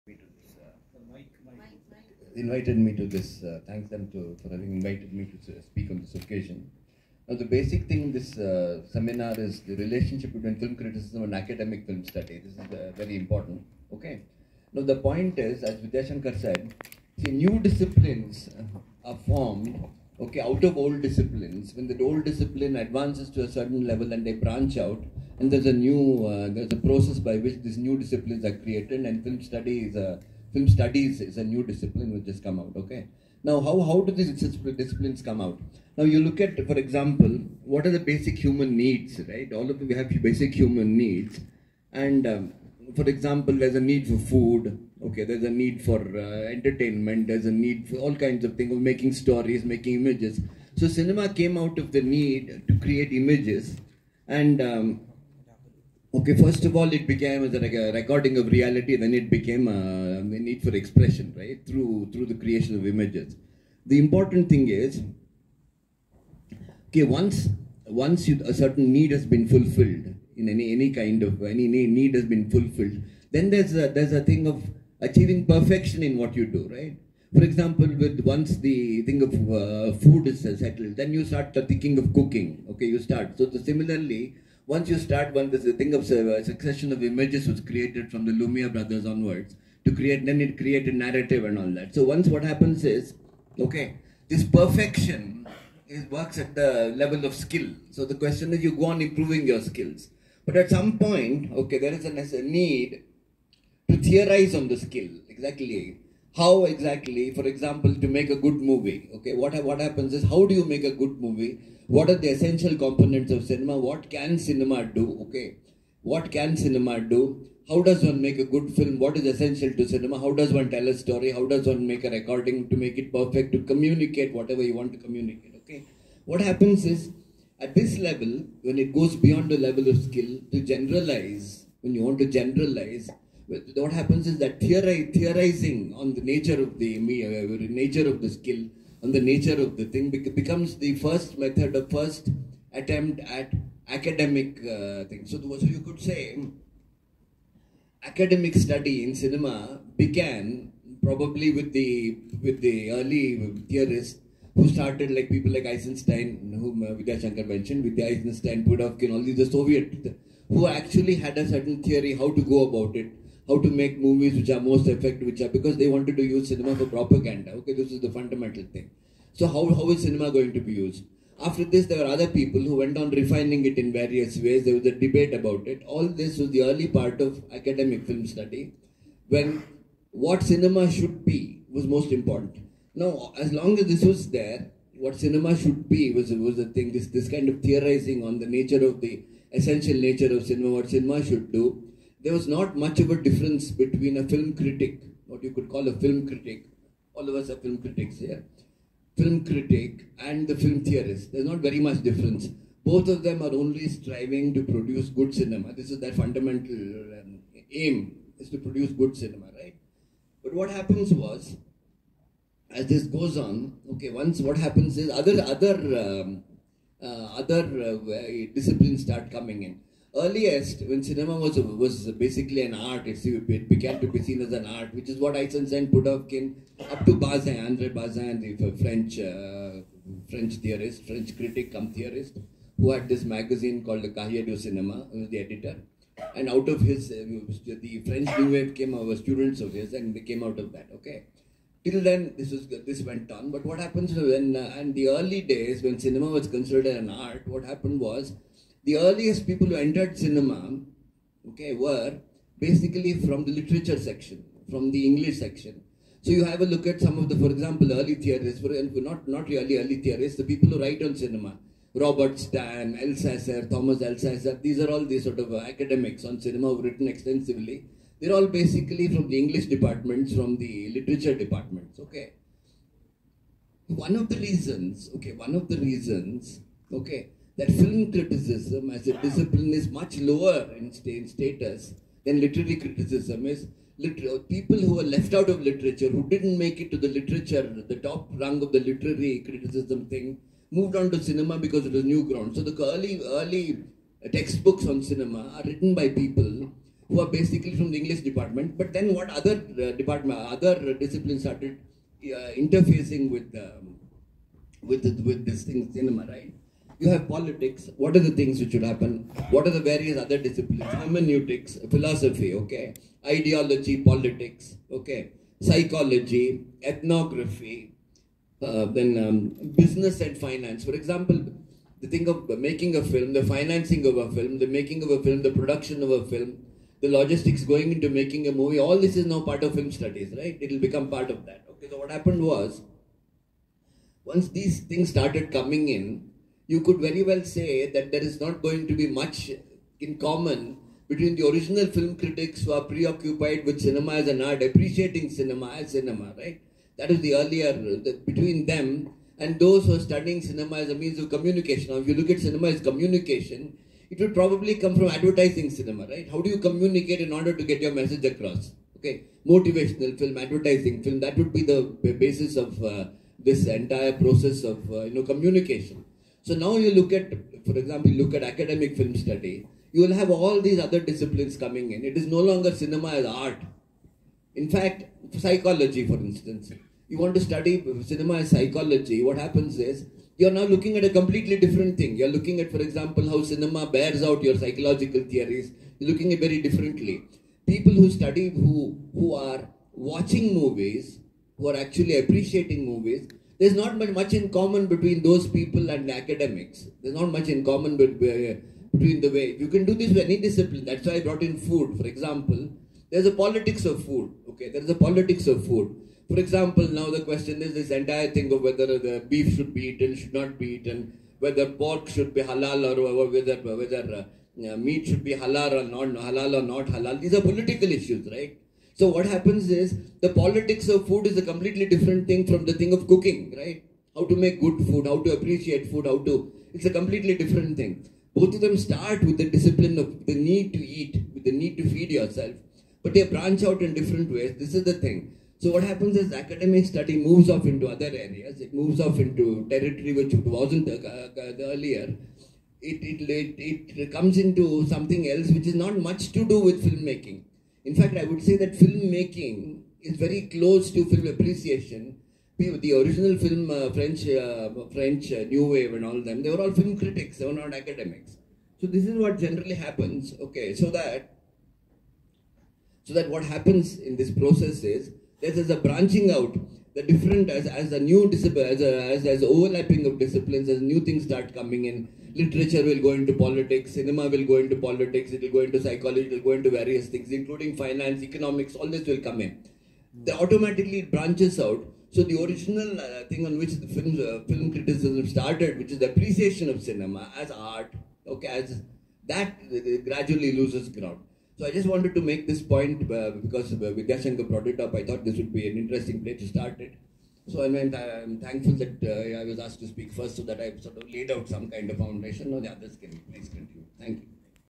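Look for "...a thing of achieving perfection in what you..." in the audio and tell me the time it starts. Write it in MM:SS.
01:14.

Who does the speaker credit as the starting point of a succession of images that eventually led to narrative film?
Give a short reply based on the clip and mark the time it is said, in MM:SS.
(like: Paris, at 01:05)
The Lumière brothers, at 01:28.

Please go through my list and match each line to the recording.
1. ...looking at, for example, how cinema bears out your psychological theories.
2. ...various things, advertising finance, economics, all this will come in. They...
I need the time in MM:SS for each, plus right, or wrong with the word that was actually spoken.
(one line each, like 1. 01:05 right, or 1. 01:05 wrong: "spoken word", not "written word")
1. 06:22 right
2. 07:56 wrong: "including", not "advertising".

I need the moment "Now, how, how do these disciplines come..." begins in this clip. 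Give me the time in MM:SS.
00:33.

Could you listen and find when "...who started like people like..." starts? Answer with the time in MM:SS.
02:34.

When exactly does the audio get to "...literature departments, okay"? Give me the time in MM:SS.
04:30.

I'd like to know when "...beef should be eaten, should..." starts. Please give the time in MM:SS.
06:49.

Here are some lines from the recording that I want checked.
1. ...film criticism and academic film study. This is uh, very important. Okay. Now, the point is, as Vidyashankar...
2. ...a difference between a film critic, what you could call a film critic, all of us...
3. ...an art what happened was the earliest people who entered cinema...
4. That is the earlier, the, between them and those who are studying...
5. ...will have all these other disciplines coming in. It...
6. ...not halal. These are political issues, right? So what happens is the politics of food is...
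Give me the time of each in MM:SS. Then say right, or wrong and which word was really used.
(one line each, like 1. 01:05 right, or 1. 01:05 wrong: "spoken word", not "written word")
1. 00:10 right
2. 03:13 right
3. 04:06 right
4. 05:46 right
5. 06:10 right
6. 06:56 right.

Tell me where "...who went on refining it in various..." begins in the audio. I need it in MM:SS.
02:52.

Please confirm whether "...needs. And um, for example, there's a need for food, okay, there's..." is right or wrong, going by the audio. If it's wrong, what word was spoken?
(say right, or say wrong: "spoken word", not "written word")
right.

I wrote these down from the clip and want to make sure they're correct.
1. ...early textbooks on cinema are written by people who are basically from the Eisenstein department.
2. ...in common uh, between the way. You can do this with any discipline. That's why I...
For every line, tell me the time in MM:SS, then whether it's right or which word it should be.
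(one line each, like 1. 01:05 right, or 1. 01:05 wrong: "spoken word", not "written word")
1. 04:53 wrong: "English", not "Eisenstein"
2. 06:37 right.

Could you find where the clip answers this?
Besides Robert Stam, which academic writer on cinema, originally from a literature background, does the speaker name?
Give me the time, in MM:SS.
04:23.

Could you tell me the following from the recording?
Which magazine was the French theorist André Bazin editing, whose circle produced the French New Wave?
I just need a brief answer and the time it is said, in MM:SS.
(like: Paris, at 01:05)
Cahiers du cinema, at 03:54.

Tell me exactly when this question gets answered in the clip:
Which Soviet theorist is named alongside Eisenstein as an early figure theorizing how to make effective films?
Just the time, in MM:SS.
02:38.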